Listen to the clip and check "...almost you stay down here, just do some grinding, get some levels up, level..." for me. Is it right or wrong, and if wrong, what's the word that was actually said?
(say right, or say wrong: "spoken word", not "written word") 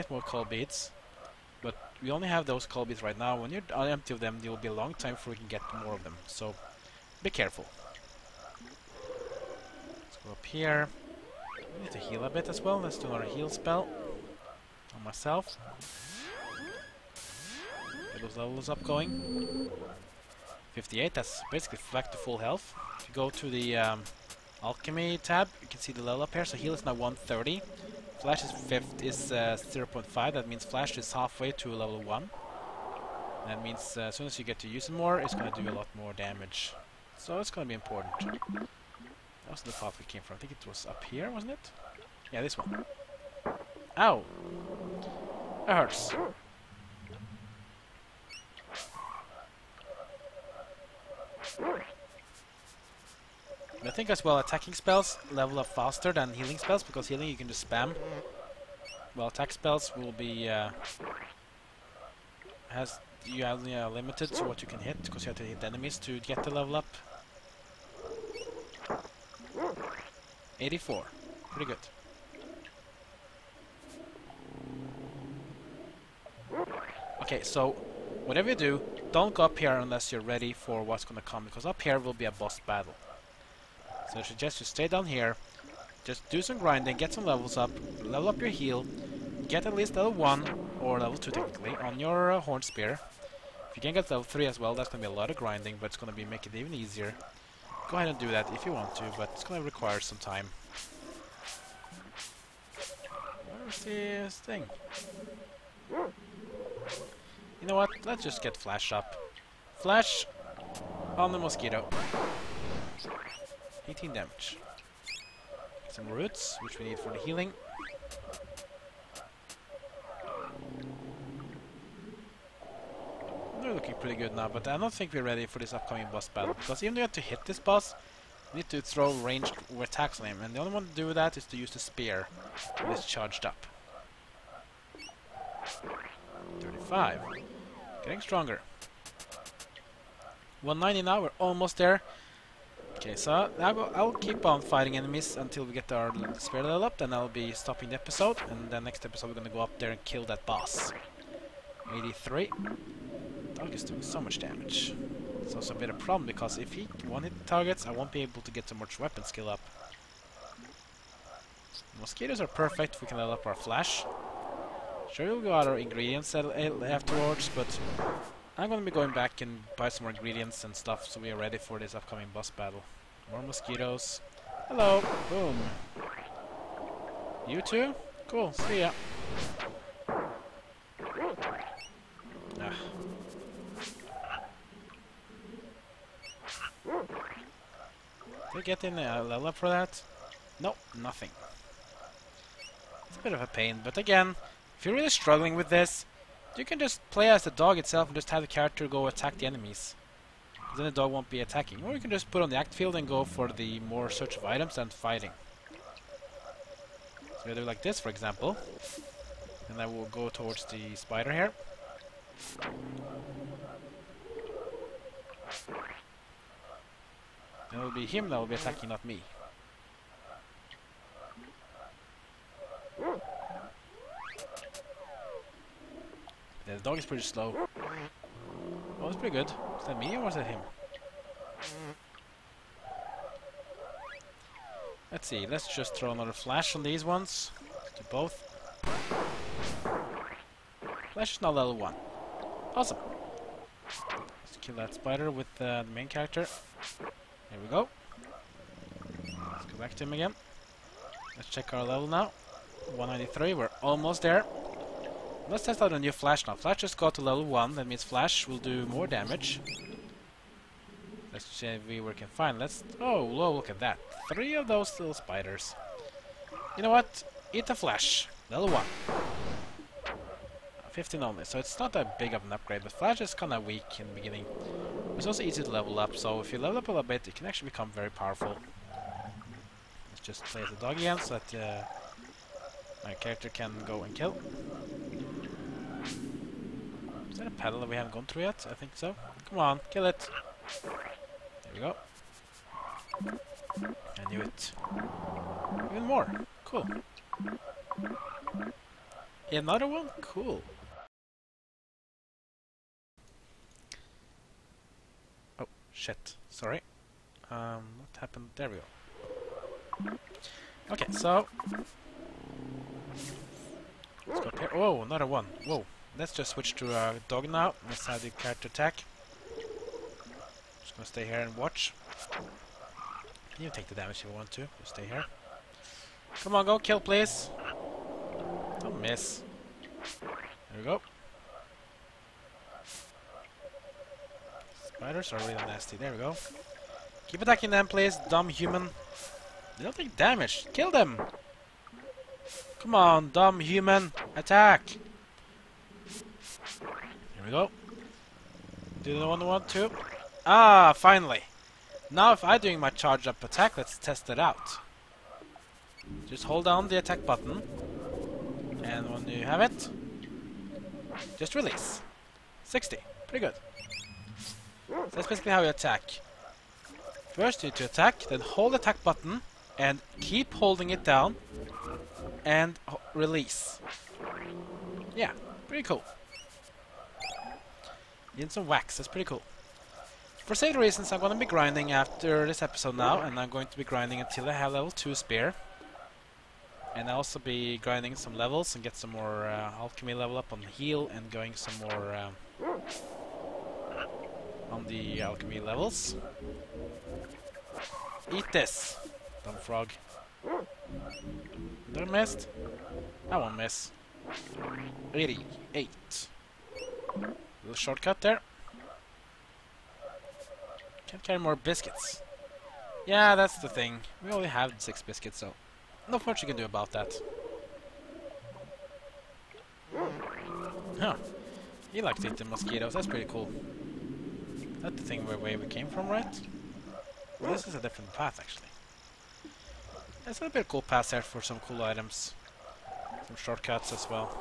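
wrong: "suggest", not "almost".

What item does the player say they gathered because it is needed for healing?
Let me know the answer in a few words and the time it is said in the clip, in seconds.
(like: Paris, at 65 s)
Roots, at 115 s.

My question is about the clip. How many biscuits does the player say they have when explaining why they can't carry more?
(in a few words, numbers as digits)
6.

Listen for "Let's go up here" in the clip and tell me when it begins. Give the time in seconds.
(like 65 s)
8 s.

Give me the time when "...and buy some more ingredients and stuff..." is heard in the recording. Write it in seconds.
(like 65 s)
169 s.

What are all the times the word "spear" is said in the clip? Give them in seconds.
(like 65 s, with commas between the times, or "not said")
92 s, 131 s, 146 s, 385 s.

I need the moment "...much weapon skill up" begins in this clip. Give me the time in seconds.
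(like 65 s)
158 s.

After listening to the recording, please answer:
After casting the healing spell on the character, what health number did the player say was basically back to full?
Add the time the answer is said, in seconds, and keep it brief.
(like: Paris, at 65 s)
58, at 20 s.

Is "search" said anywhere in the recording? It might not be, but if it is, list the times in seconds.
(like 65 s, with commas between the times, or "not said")
204 s.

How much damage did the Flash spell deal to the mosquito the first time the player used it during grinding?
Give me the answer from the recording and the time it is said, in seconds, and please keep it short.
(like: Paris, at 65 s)
18, at 113 s.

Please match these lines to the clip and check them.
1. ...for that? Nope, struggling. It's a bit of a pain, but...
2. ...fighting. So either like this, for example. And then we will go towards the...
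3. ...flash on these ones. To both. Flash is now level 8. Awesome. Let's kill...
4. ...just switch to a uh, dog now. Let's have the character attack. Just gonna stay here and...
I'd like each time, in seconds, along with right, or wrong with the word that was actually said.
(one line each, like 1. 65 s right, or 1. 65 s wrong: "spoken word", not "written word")
1. 189 s wrong: "nothing", not "struggling"
2. 204 s right
3. 236 s wrong: "1", not "8"
4. 316 s right.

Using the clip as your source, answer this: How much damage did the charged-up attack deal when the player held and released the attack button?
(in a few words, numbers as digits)
60.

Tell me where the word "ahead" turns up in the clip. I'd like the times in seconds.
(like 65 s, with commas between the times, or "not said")
97 s.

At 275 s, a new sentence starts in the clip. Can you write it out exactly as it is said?
It's also easy to level up, so if you level up a little bit, it can actually become very powerful.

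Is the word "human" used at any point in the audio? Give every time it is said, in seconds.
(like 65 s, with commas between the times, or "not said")
338 s, 343 s.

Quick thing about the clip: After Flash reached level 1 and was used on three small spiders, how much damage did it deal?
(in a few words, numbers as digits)
15.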